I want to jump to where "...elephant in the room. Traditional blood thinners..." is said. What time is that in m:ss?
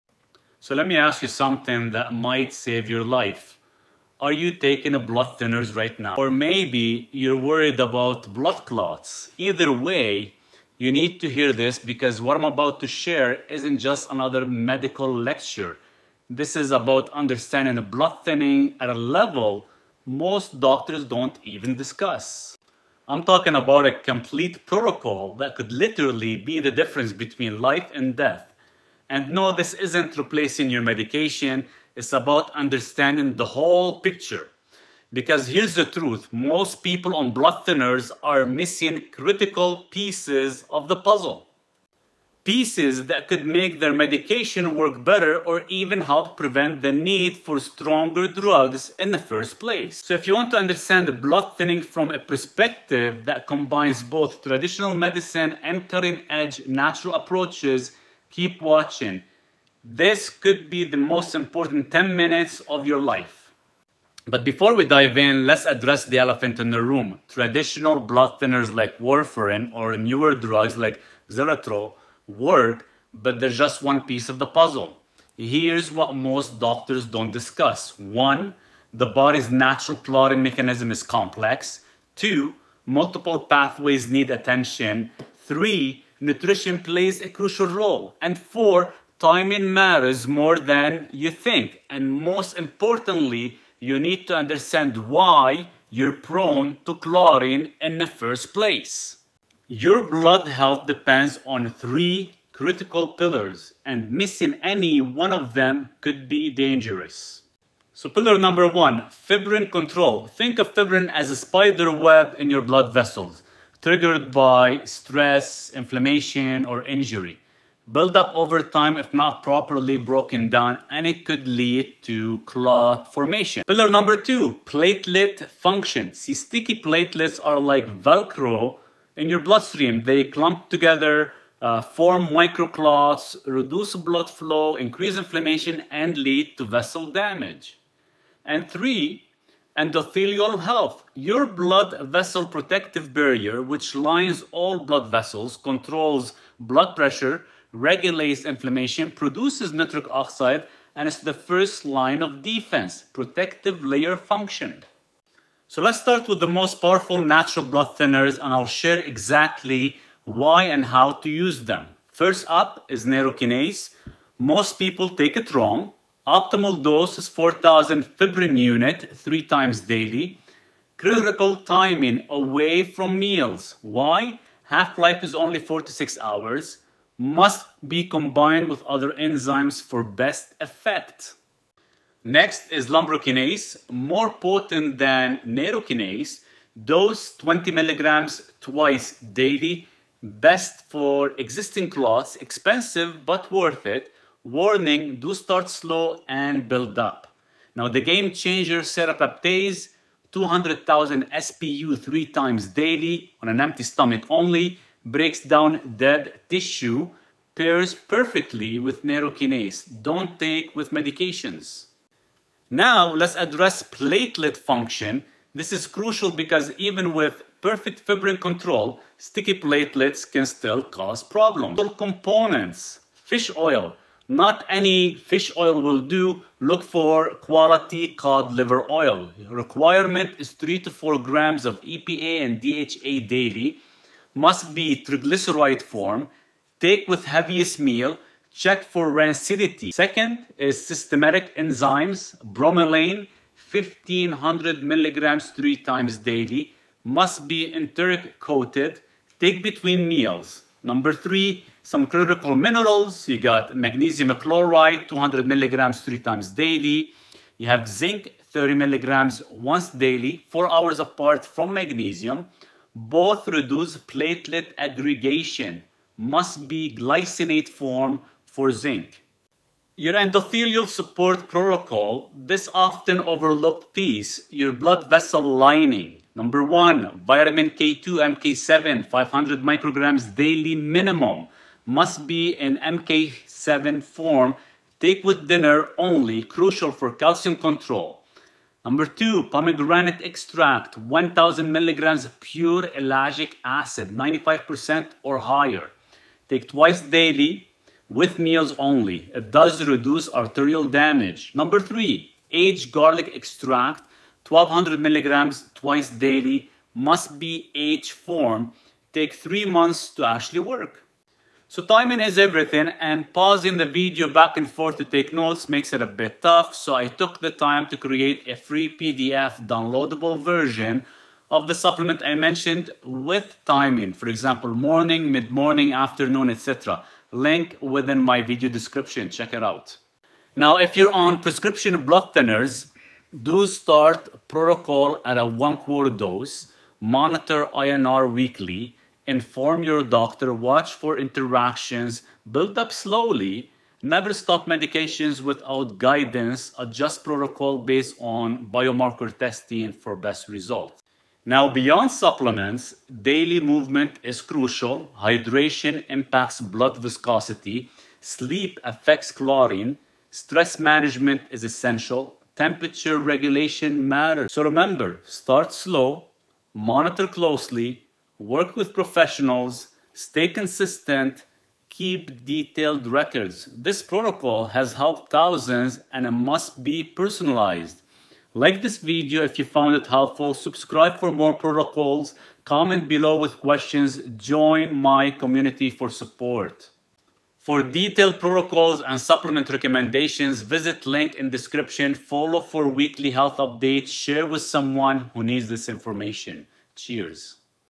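1:06.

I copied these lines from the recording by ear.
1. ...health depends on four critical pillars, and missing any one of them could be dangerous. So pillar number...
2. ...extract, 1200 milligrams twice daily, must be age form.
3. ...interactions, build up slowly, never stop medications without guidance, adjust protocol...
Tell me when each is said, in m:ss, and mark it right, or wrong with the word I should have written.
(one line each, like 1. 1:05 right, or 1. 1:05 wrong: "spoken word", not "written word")
1. 1:40 wrong: "three", not "four"
2. 5:03 right
3. 5:41 right.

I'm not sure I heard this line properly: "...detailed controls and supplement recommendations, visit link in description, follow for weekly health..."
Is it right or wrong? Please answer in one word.
wrong.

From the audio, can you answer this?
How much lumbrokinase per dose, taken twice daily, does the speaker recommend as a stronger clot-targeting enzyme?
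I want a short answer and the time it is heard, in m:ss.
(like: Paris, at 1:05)
20 milligrams, at 3:07.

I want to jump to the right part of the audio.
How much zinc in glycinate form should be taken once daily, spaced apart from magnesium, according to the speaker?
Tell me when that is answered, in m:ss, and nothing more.
4:18.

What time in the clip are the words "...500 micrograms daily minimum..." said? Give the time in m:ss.
4:39.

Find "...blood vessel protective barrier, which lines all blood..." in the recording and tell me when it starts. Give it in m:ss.
2:21.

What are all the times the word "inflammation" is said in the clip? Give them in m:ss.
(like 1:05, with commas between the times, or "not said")
1:55, 2:15, 2:28.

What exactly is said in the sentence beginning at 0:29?
And no, this isn't replacing your medication.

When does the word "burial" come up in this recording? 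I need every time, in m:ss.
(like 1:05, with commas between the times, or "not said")
not said.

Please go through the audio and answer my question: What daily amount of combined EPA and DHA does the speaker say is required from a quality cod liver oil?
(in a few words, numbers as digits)
3 to 4 grams.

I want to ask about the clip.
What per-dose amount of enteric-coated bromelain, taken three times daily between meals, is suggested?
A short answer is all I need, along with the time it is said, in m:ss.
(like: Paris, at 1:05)
1500 milligrams, at 4:03.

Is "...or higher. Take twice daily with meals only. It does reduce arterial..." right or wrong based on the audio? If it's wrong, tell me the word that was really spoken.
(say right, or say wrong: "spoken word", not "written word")
right.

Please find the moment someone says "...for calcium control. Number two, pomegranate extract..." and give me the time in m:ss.
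4:46.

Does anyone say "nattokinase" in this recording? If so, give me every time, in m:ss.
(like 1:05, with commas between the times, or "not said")
2:43, 3:05, 3:29.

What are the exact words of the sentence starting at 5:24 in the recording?
For example, morning, mid-morning, afternoon, etc.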